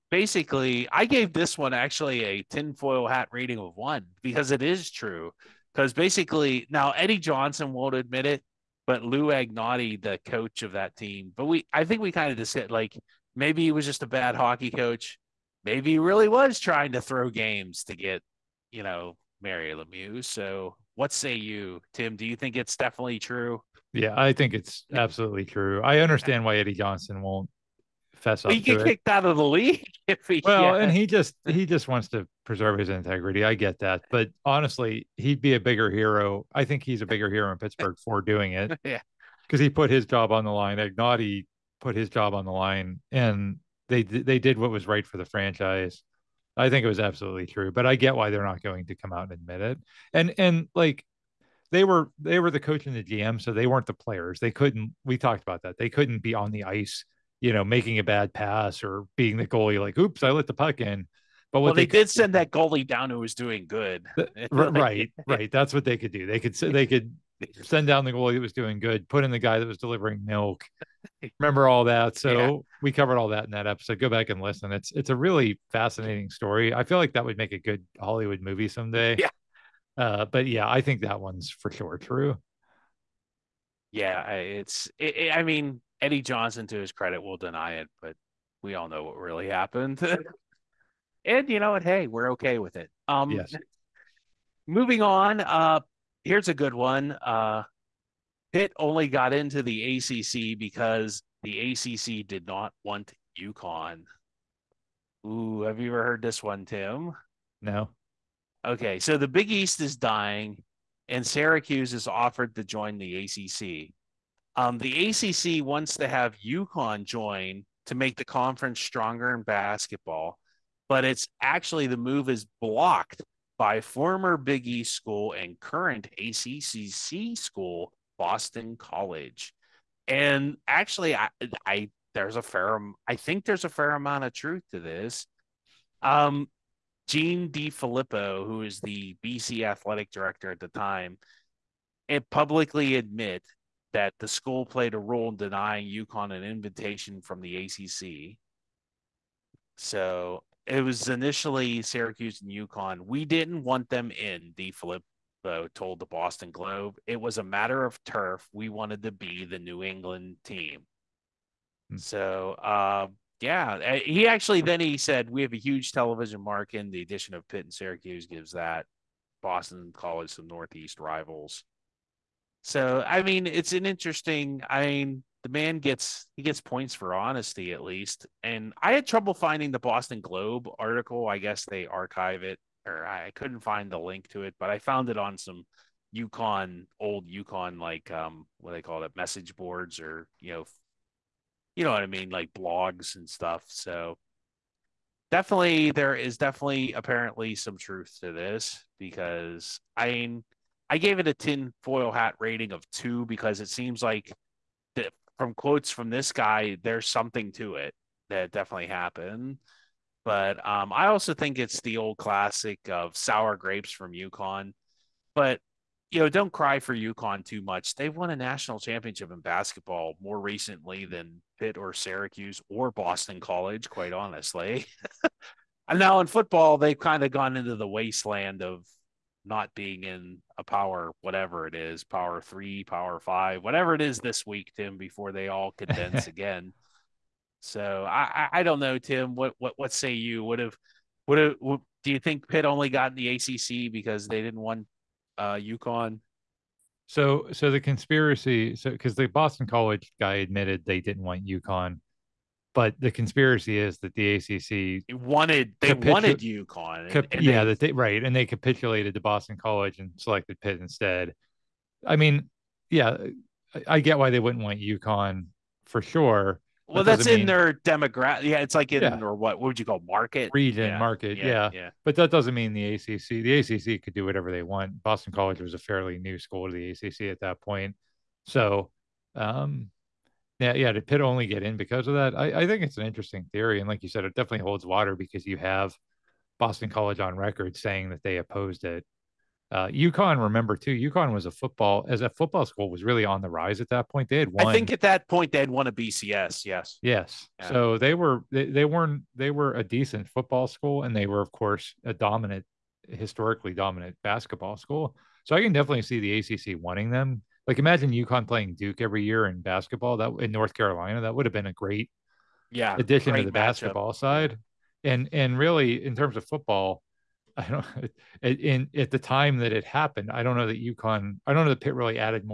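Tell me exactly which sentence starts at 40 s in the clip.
Angotti put his job on the line, and they they did what was right for the franchise.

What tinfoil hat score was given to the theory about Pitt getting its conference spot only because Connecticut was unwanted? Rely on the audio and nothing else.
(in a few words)
2.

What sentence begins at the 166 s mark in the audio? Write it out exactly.
The addition of Pitt and Syracuse gives that Boston College some Northeast rivals.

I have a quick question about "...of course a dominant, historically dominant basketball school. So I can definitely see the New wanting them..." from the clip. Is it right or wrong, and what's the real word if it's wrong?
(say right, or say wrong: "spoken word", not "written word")
wrong: "ACC", not "New".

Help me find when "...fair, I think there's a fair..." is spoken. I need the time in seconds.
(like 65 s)
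132 s.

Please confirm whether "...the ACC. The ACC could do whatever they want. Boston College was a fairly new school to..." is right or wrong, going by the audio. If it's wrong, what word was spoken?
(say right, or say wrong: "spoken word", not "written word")
right.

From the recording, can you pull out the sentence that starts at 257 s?
And, cap- and yeah, they, that they, right, and they capitulated to Boston College and selected Pitt instead.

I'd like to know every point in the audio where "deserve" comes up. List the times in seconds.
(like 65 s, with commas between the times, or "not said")
not said.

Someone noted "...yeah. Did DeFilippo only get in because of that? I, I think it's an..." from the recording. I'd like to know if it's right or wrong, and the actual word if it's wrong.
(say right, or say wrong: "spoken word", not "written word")
wrong: "Pitt", not "DeFilippo".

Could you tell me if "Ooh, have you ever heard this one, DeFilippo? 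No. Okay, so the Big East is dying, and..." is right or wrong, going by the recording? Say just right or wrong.
wrong.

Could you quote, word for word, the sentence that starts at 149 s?
So it was initially Syracuse and UConn.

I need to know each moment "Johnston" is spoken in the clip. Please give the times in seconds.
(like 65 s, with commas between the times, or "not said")
7 s, 26 s, 86 s.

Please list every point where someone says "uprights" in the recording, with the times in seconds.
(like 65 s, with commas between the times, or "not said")
not said.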